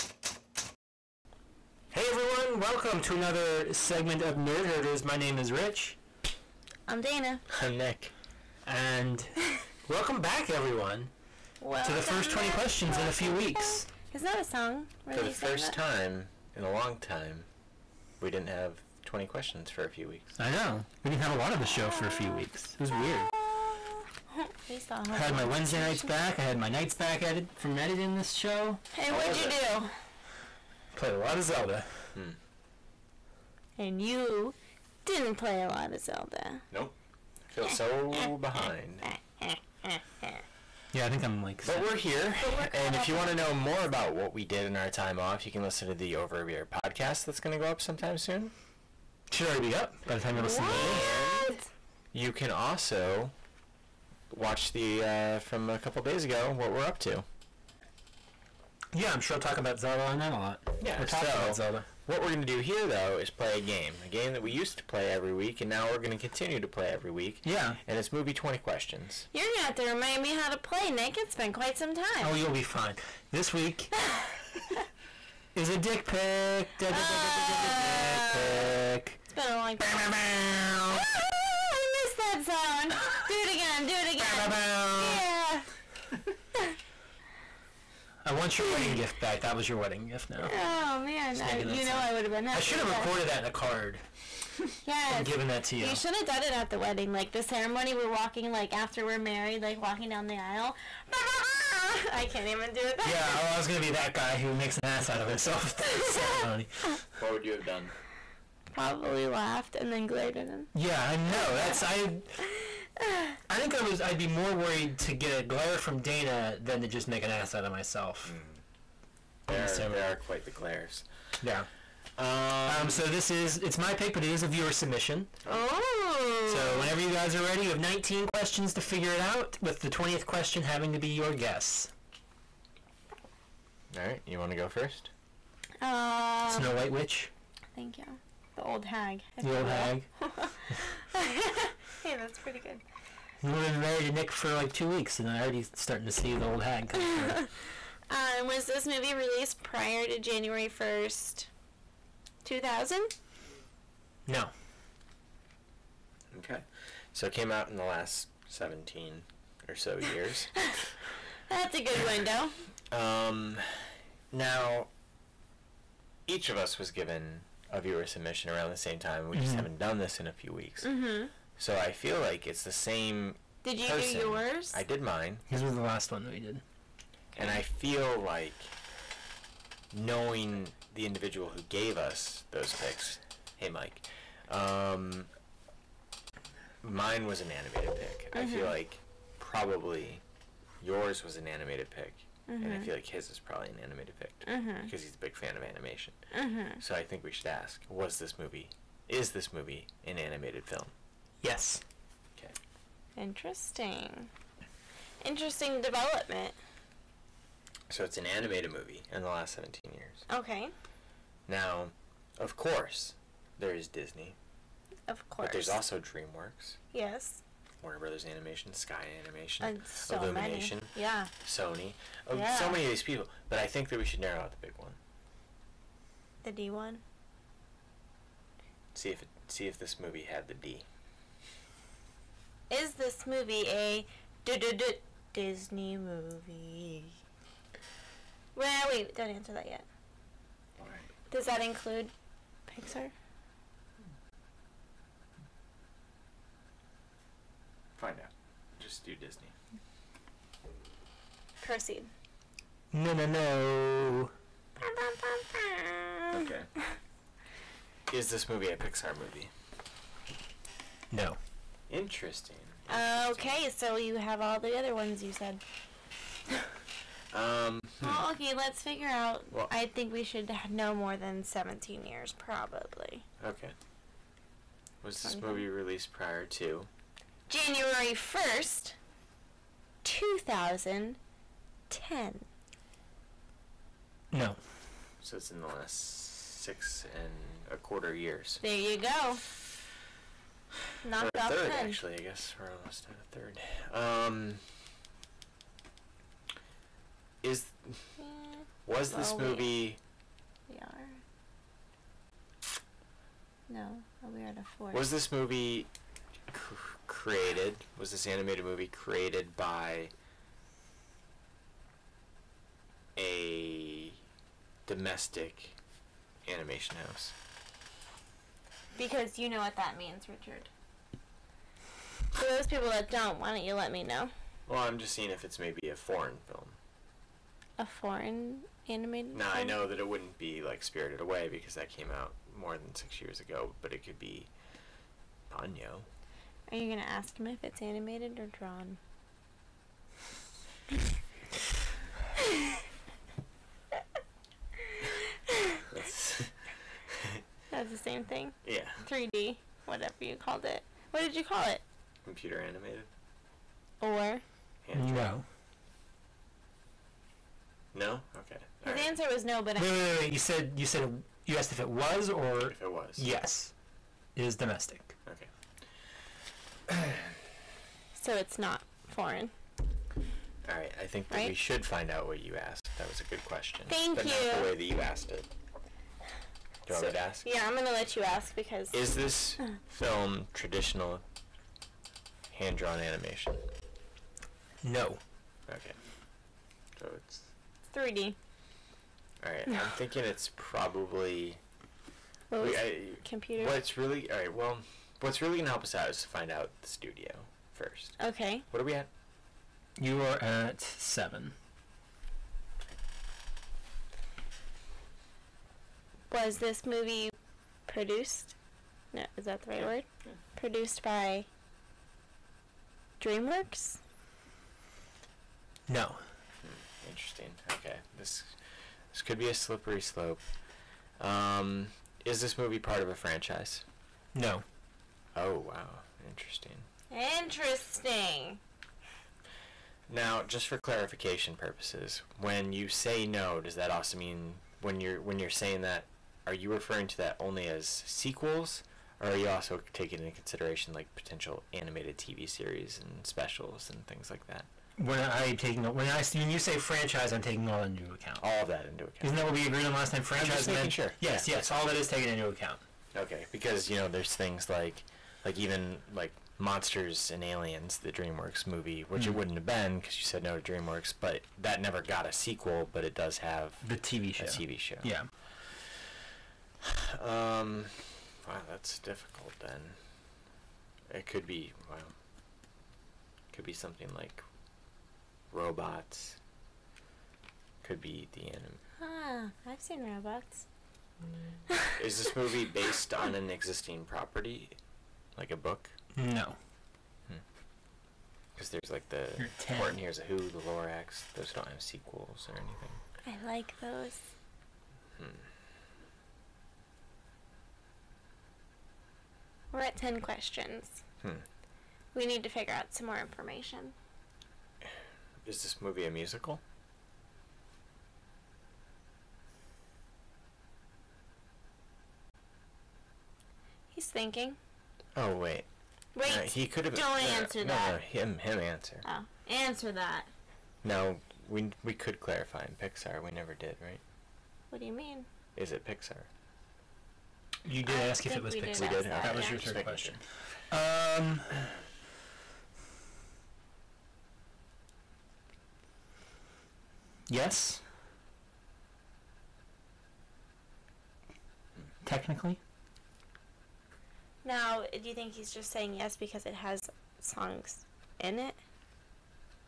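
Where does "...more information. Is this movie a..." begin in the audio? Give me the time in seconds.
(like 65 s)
503 s.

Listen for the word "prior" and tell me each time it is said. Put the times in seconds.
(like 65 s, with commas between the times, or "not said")
149 s, 276 s.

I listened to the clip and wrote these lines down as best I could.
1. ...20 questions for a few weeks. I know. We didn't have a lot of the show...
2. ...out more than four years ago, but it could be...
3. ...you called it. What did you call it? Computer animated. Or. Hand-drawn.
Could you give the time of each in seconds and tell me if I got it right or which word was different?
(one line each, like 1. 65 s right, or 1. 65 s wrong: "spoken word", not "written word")
1. 19 s right
2. 332 s wrong: "six", not "four"
3. 350 s right.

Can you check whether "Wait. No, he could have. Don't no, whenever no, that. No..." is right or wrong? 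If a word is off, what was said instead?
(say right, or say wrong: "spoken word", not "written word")
wrong: "answer", not "whenever".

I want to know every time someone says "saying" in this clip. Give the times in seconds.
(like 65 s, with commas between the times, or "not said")
435 s, 545 s.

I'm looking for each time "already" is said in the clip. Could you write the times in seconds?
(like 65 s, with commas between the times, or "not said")
49 s, 145 s.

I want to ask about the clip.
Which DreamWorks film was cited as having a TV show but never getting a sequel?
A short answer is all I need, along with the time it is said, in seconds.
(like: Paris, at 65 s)
Monsters and Aliens, at 456 s.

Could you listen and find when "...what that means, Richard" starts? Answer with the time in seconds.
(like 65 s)
319 s.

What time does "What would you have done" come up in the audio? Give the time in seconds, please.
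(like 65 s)
107 s.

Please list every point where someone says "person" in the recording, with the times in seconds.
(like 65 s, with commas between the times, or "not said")
173 s.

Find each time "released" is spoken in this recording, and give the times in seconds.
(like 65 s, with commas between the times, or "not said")
149 s, 275 s.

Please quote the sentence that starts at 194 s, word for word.
because he's a big fan of animation.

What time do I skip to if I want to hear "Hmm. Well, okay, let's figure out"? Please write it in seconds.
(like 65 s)
268 s.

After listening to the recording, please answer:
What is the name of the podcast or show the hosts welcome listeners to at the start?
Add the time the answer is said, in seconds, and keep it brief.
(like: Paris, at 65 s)
Nerd Herders, at 4 s.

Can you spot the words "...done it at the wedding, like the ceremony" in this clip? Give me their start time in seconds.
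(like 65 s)
96 s.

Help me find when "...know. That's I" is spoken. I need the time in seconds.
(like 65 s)
111 s.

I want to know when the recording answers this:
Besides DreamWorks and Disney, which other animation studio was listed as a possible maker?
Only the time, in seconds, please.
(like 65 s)
218 s.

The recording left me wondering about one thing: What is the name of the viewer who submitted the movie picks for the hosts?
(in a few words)
Mike.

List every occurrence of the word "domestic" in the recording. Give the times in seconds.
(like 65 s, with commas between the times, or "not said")
314 s, 364 s.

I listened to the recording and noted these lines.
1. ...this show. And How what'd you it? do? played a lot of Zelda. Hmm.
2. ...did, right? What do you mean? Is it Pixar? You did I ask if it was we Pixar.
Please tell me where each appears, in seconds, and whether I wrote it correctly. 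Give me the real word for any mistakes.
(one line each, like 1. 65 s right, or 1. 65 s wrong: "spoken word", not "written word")
1. 28 s right
2. 523 s right.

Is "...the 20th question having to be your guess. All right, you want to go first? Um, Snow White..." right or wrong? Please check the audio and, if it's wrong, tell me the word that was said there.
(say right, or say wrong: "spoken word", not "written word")
right.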